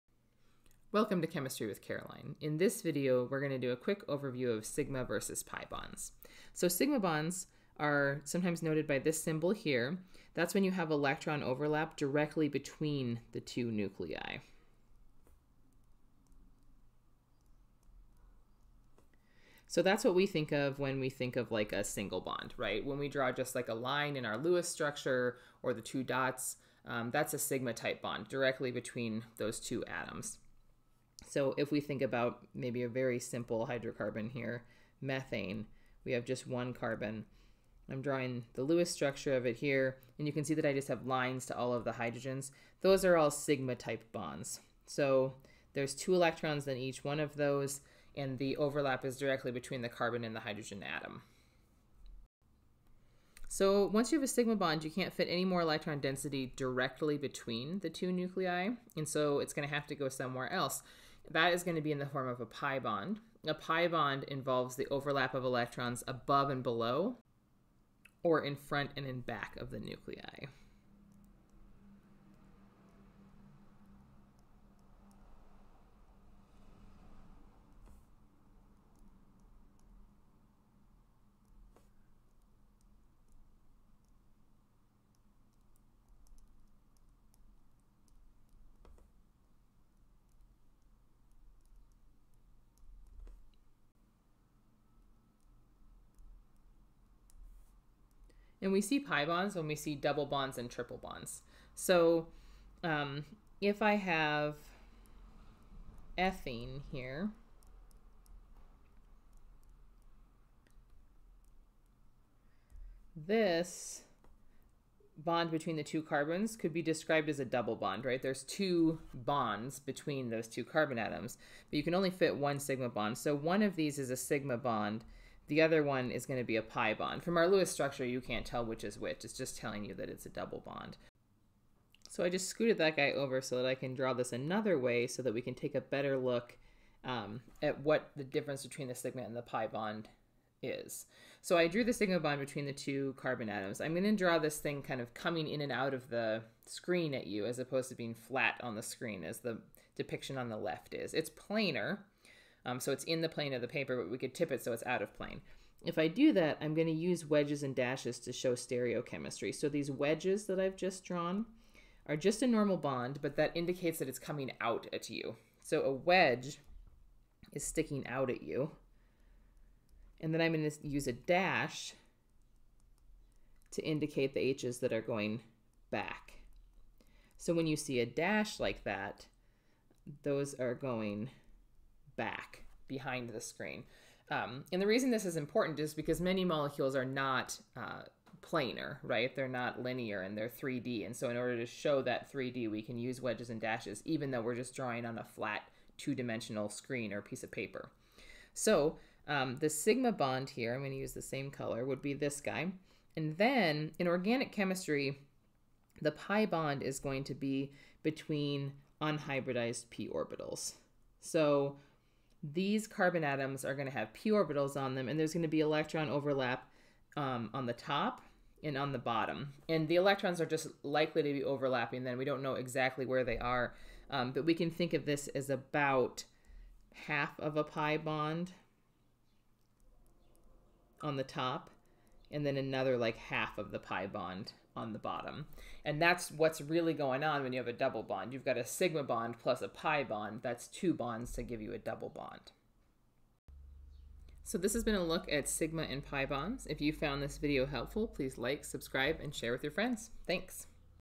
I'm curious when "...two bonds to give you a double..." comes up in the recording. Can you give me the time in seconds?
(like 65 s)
240 s.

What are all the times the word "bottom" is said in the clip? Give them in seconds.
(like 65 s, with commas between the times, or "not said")
218 s, 234 s.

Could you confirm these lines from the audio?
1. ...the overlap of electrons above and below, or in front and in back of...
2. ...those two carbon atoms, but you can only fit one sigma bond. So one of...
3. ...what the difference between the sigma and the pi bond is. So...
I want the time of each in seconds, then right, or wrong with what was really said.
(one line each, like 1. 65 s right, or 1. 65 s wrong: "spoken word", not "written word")
1. 64 s right
2. 120 s right
3. 137 s right.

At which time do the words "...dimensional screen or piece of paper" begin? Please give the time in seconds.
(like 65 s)
196 s.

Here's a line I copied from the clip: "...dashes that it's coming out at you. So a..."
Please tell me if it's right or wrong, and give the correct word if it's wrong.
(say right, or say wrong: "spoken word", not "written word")
wrong: "indicates", not "dashes".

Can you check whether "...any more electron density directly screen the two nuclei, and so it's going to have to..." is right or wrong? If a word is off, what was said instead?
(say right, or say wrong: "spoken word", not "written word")
wrong: "between", not "screen".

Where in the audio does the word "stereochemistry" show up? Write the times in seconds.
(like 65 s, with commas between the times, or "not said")
158 s.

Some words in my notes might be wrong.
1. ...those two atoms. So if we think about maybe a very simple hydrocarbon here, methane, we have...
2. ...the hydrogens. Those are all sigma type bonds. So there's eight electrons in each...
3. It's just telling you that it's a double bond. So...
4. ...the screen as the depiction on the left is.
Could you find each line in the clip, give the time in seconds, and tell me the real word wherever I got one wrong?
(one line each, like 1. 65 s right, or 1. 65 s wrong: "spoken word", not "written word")
1. 29 s right
2. 41 s wrong: "two", not "eight"
3. 129 s right
4. 148 s right.